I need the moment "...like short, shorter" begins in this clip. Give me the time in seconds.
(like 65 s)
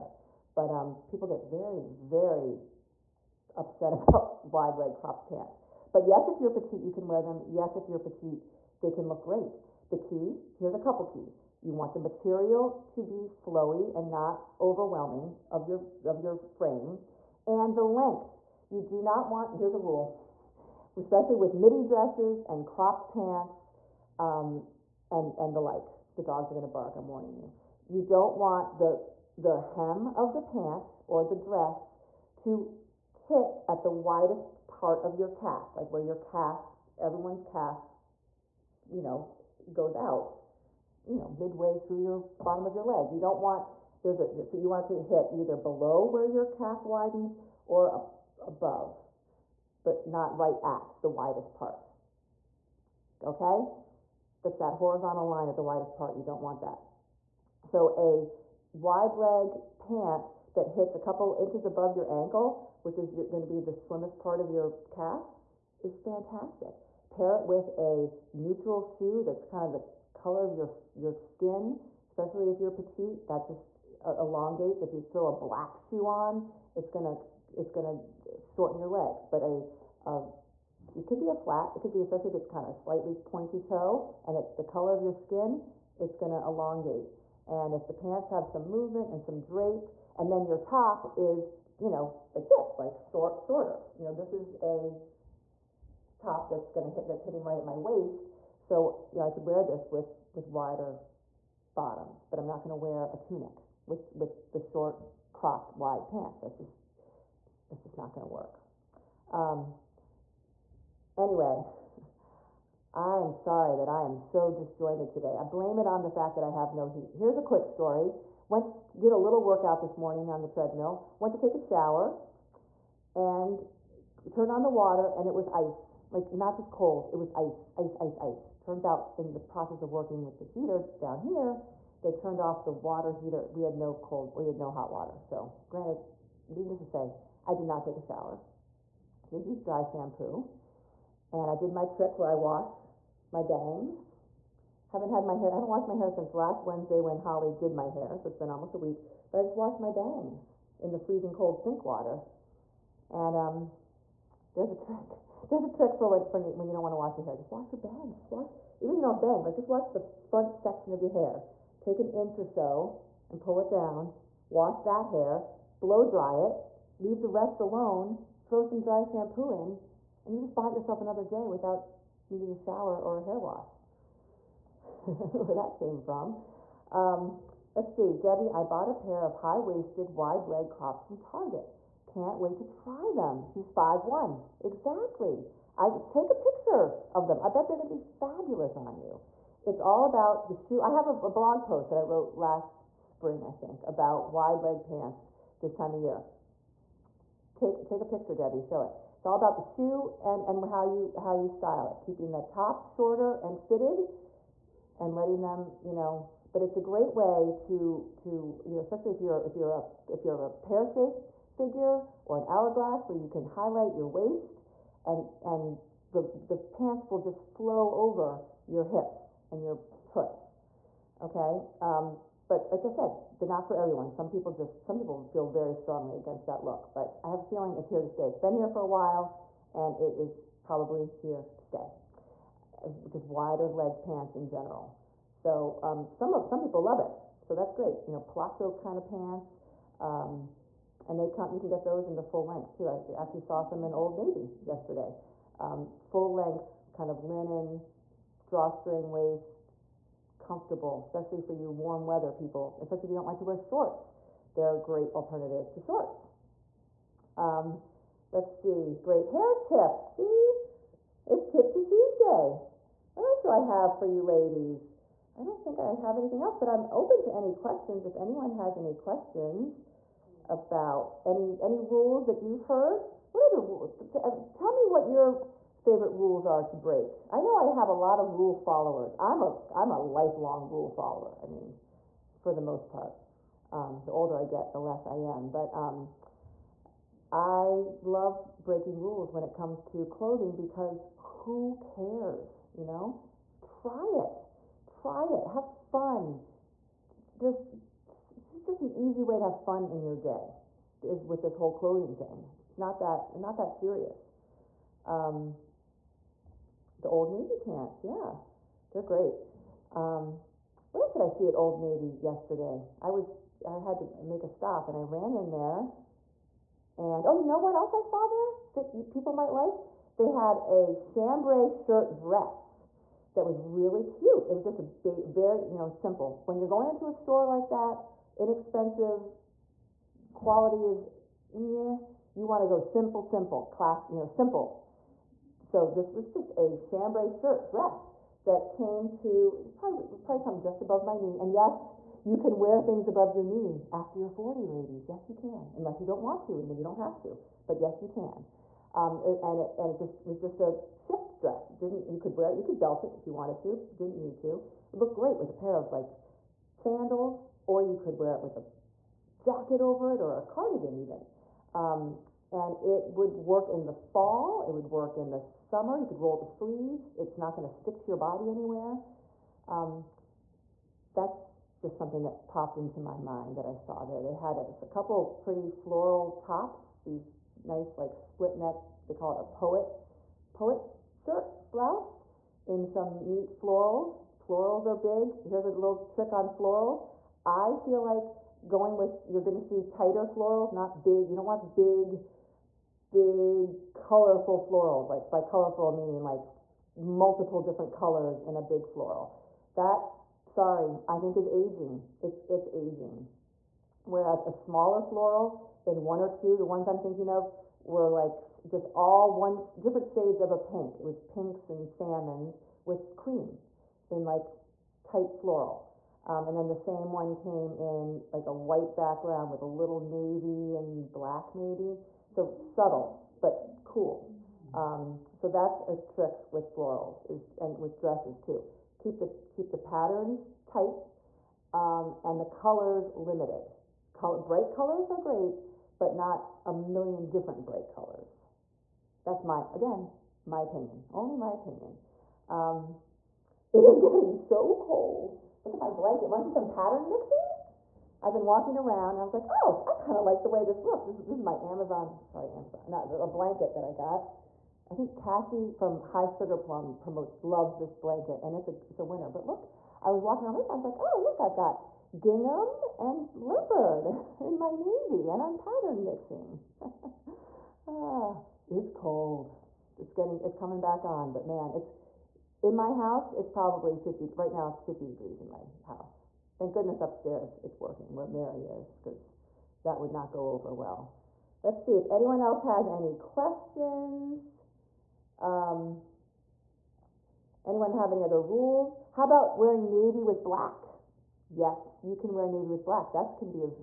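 92 s.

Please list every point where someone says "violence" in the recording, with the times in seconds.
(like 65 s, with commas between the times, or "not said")
not said.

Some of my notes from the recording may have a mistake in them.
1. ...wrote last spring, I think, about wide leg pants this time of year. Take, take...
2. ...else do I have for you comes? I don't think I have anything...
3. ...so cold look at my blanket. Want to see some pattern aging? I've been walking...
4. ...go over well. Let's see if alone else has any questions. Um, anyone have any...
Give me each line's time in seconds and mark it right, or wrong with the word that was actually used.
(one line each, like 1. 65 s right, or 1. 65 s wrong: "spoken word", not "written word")
1. 192 s right
2. 263 s wrong: "ladies", not "comes"
3. 444 s wrong: "mixing", not "aging"
4. 480 s wrong: "anyone", not "alone".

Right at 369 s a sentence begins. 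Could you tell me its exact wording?
Um, that's just something that popped into my mind that I saw there.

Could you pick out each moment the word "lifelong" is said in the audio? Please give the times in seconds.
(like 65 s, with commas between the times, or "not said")
280 s.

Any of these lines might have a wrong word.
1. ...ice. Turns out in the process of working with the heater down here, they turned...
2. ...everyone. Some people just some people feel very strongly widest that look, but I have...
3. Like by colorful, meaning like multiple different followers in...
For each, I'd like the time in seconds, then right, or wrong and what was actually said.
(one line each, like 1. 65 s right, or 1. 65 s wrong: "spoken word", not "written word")
1. 128 s right
2. 223 s wrong: "against", not "widest"
3. 395 s wrong: "colors", not "followers".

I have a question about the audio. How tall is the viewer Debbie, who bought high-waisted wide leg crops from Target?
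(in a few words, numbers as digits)
5'1".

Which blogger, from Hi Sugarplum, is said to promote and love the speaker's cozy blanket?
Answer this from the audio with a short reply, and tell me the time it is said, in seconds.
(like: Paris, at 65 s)
Cassie, at 455 s.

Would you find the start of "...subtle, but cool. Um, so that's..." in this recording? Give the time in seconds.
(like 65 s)
422 s.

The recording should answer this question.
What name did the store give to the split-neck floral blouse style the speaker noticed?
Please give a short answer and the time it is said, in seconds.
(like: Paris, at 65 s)
poet shirt, at 380 s.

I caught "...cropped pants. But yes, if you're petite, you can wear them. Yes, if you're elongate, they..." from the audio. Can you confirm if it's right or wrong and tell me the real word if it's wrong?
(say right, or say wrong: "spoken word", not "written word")
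wrong: "petite", not "elongate".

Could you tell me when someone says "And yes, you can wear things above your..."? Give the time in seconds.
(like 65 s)
341 s.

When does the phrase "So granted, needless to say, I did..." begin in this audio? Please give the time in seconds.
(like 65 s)
135 s.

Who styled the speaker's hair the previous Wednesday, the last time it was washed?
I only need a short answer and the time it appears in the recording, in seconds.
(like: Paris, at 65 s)
Holly, at 147 s.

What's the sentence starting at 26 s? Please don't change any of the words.
The dogs are gonna bark, I'm warning you.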